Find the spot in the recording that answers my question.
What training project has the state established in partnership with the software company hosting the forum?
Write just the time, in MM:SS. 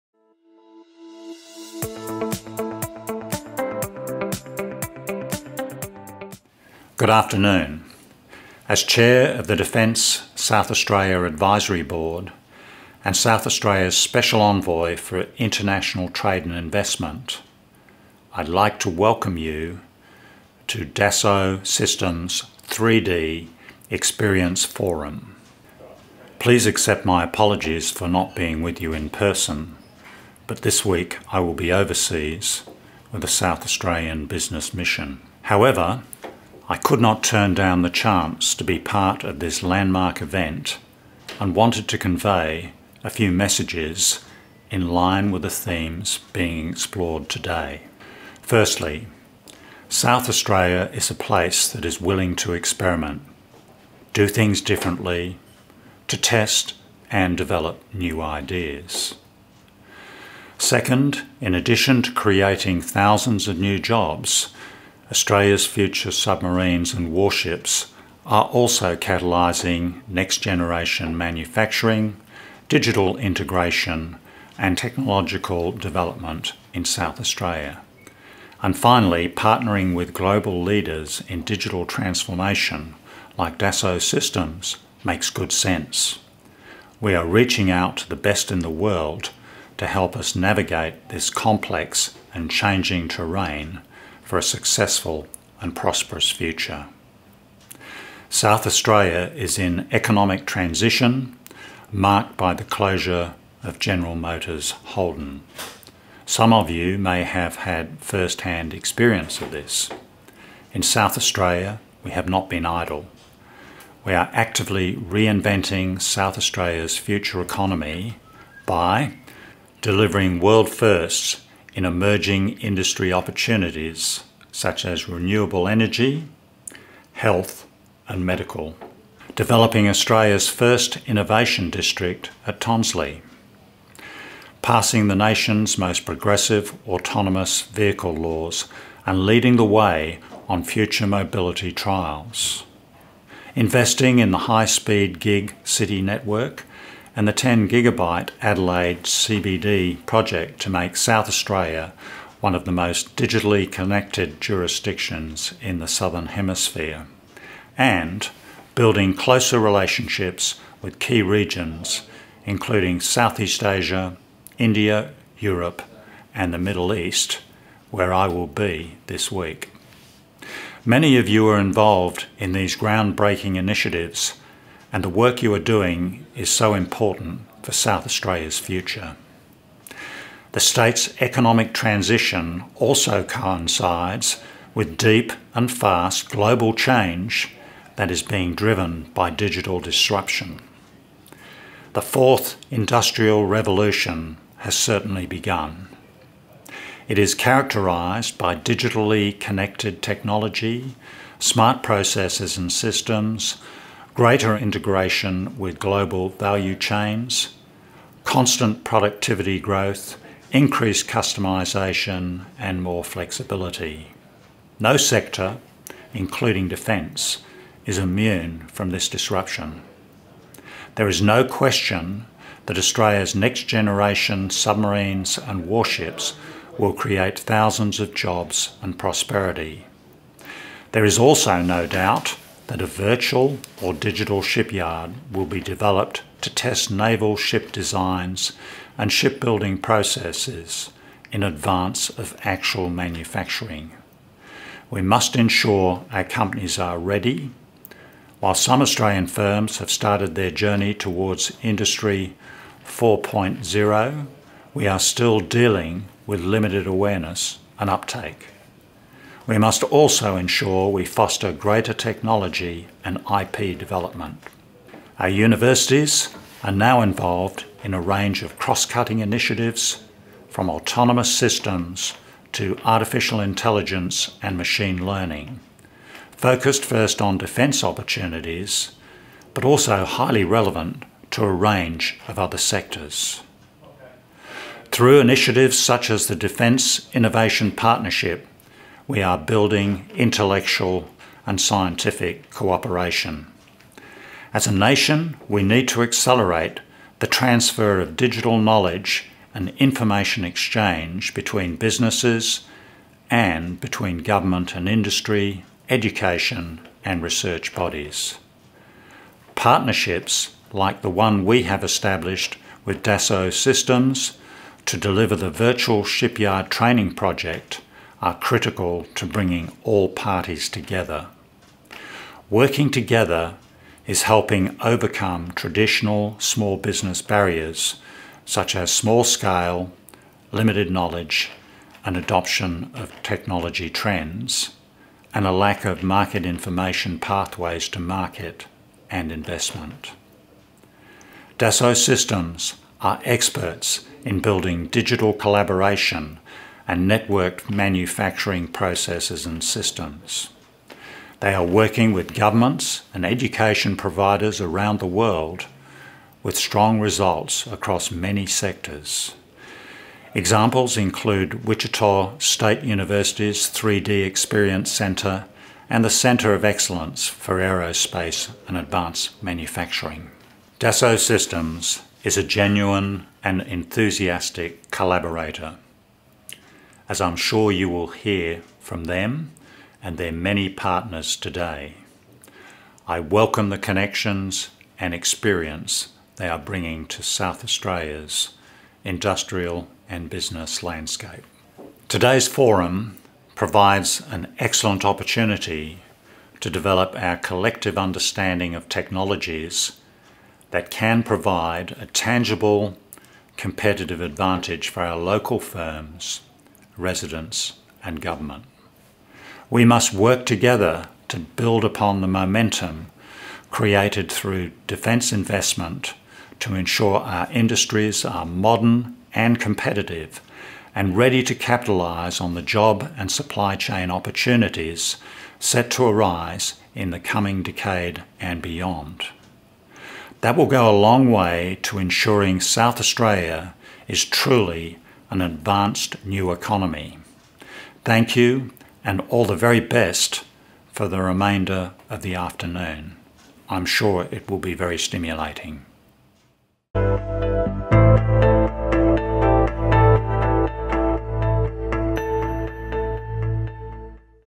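05:15.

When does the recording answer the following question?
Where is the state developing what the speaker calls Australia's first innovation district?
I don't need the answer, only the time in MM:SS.
02:12.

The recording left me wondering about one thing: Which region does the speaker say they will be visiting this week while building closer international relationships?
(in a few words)
Middle East.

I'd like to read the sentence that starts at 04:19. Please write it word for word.
We must also ensure we foster greater technology and IP development.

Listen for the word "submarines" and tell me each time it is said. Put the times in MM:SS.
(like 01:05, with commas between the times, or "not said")
01:06, 03:44.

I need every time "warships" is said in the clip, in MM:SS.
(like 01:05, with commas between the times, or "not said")
01:07, 03:45.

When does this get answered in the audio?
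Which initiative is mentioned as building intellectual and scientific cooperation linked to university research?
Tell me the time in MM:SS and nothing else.
04:46.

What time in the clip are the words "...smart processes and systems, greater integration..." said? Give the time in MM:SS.
03:21.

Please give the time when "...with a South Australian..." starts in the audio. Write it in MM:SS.
00:33.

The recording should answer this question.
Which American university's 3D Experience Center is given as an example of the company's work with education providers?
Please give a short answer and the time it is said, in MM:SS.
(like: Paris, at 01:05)
Wichita State University, at 06:01.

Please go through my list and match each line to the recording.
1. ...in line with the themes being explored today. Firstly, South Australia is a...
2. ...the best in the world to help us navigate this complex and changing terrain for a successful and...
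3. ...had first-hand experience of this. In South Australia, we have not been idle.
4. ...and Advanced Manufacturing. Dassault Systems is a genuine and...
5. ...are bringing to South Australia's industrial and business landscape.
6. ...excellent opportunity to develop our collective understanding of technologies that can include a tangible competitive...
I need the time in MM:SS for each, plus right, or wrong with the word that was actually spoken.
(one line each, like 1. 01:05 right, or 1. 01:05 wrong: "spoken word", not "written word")
1. 00:44 right
2. 01:28 right
3. 01:47 right
4. 06:08 right
5. 06:26 right
6. 06:34 wrong: "provide", not "include".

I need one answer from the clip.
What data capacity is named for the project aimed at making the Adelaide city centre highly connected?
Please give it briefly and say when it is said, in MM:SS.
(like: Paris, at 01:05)
10 gigabyte, at 02:27.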